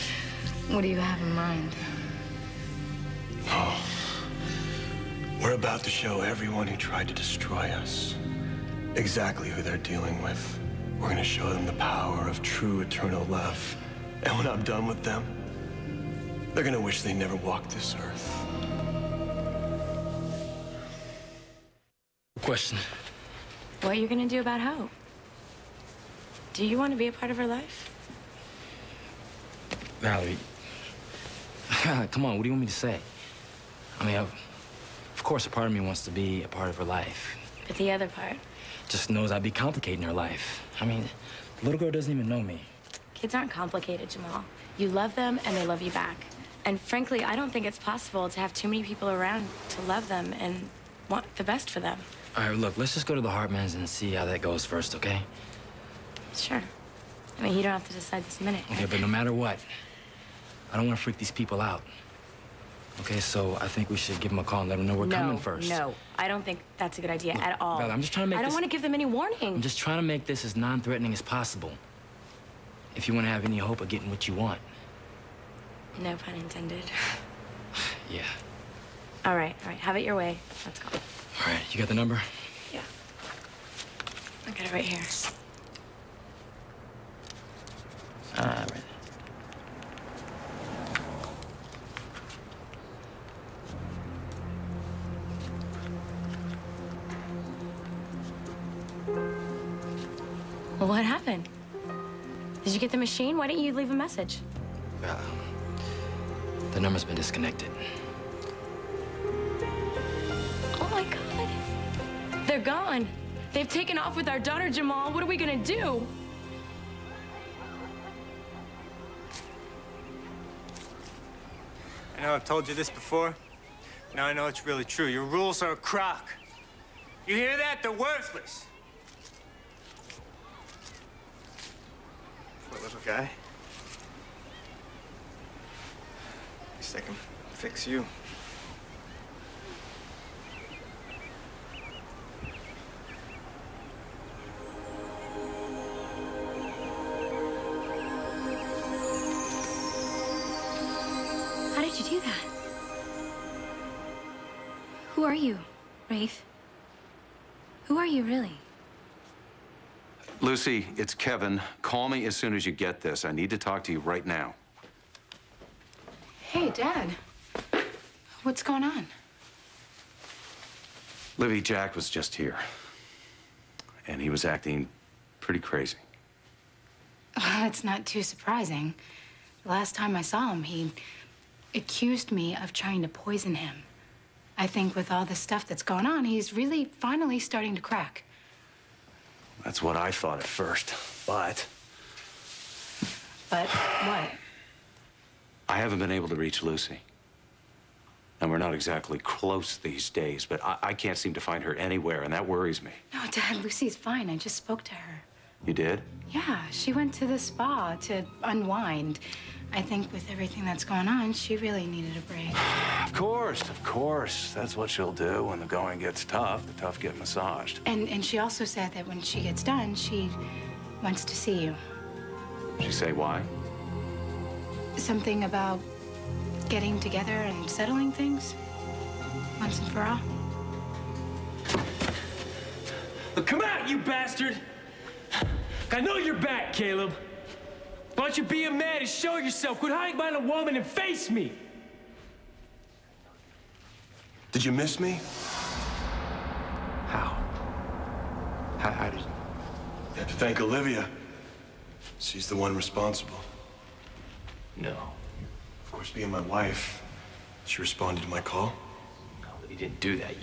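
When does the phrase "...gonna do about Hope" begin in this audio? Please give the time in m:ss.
0:24.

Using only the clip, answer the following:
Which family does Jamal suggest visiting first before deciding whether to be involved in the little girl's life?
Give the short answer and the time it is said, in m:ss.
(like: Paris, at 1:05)
The Hartmans, at 0:53.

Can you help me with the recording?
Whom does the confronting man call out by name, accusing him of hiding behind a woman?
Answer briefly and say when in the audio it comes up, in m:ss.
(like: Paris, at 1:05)
Caleb, at 3:56.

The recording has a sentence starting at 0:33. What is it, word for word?
I mean, of course, a part of me wants to be a part of her life.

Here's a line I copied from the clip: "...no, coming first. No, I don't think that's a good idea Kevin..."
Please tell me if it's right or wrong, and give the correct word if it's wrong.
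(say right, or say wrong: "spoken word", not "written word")
wrong: "Look", not "Kevin".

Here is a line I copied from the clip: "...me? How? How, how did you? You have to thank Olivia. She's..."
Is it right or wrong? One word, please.
right.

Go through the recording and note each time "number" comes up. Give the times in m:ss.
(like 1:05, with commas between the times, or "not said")
1:21, 1:46.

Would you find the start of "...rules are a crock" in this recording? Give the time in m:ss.
2:05.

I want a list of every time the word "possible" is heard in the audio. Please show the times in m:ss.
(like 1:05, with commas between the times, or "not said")
0:47, 1:11.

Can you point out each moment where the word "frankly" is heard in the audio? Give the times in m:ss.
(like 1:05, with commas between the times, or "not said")
0:46.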